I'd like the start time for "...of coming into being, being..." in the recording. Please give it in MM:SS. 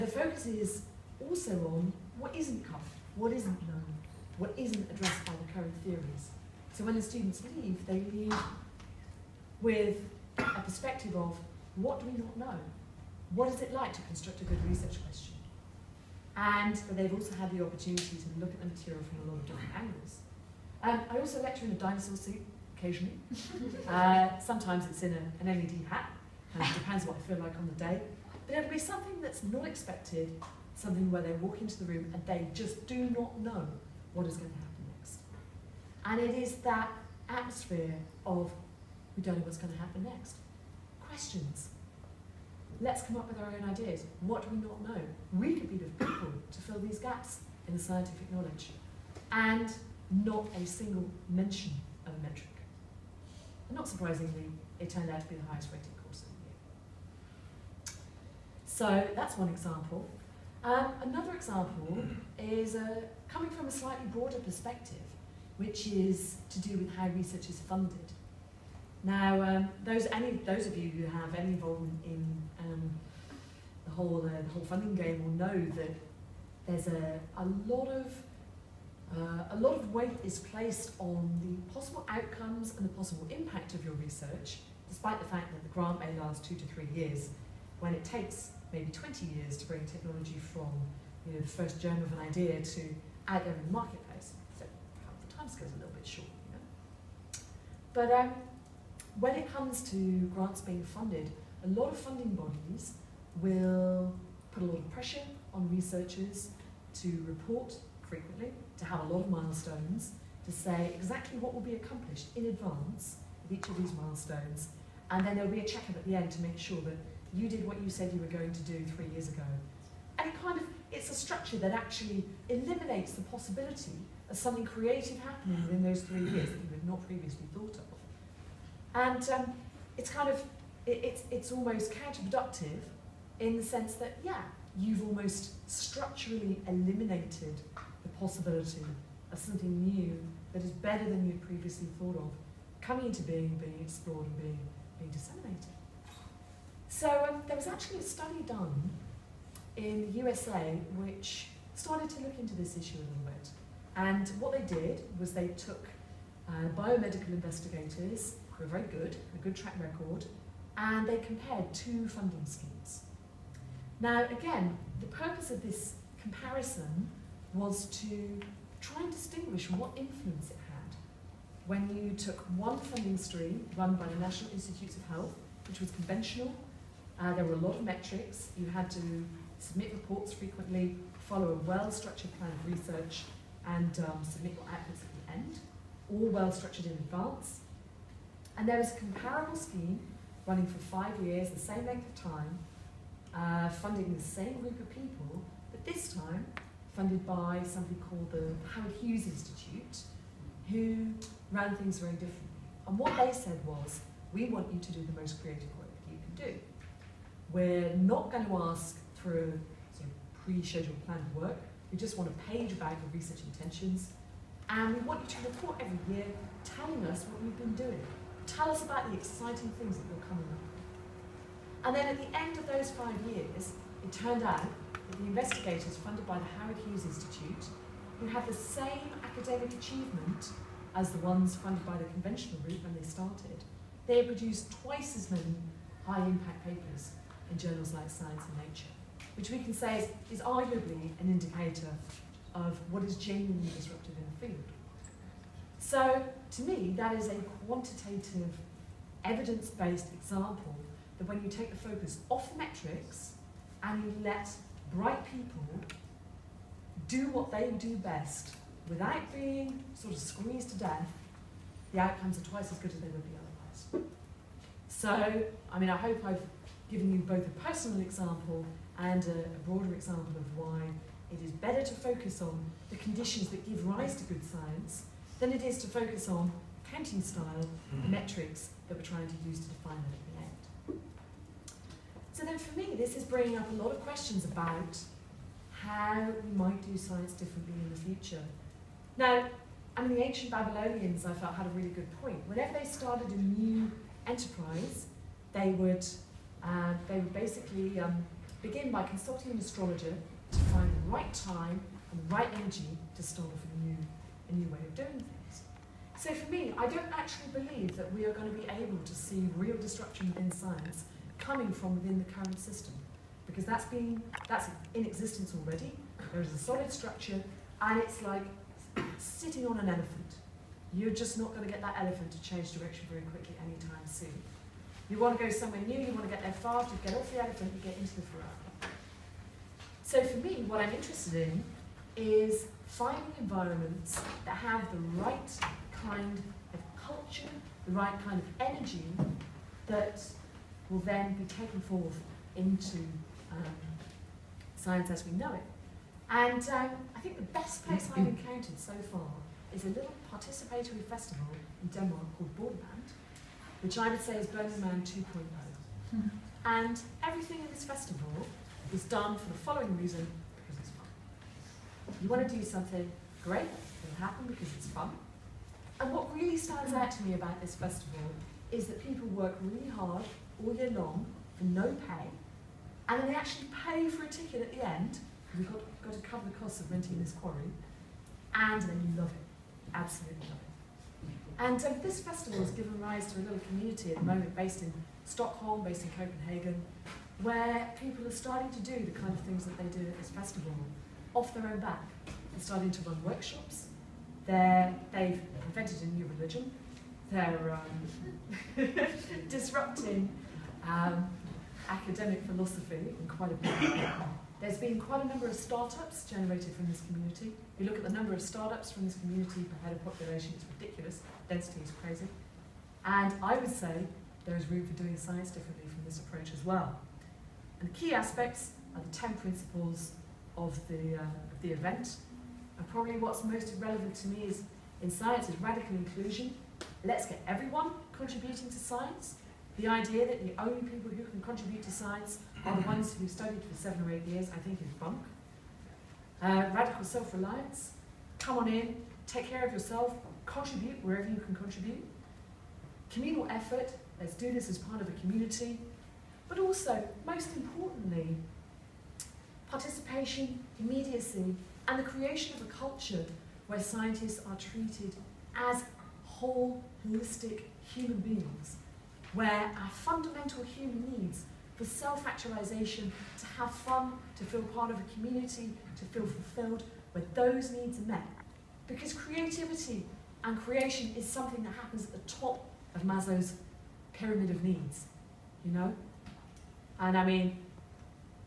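02:22.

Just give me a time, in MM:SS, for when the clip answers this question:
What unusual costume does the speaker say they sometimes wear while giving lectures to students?
00:21.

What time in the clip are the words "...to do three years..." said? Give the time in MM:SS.
01:58.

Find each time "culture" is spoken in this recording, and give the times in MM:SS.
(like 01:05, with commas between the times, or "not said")
05:37, 07:32.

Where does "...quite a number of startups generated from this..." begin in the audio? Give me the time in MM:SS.
06:44.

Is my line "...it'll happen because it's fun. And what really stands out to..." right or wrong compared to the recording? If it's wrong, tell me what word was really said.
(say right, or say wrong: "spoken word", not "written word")
right.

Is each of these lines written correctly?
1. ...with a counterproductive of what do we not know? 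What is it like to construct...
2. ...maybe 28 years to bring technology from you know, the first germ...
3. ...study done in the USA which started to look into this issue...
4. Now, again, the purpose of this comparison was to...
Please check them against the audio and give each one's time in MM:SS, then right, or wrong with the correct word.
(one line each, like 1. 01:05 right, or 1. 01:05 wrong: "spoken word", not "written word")
1. 00:09 wrong: "perspective", not "counterproductive"
2. 01:28 wrong: "20", not "28"
3. 02:28 right
4. 02:43 right.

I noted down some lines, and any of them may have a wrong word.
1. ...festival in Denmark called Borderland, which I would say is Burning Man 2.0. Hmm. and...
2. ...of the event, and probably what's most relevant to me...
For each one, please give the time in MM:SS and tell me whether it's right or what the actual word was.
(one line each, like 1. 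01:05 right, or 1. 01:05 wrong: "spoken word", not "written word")
1. 05:51 right
2. 07:01 right.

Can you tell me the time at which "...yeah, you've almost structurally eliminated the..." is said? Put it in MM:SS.
02:14.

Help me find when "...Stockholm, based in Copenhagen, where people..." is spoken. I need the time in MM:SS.
06:25.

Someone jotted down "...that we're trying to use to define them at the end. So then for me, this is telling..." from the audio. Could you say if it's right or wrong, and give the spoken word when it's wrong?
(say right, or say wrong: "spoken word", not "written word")
wrong: "bringing", not "telling".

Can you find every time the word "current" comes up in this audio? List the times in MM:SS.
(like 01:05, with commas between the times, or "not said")
00:05, 05:12.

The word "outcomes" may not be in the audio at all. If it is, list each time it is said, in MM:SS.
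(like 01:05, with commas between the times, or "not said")
01:22, 04:21.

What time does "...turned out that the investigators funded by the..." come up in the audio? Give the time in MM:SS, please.
03:44.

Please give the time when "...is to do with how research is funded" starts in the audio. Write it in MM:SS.
01:05.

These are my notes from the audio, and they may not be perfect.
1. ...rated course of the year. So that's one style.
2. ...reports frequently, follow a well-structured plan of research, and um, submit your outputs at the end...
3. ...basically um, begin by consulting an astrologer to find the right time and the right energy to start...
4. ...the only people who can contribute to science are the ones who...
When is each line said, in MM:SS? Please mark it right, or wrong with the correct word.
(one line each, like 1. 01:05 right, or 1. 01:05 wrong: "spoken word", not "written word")
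1. 00:55 wrong: "example", not "style"
2. 02:59 right
3. 04:57 right
4. 07:10 right.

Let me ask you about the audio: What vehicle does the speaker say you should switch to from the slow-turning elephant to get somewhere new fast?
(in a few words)
Ferrari.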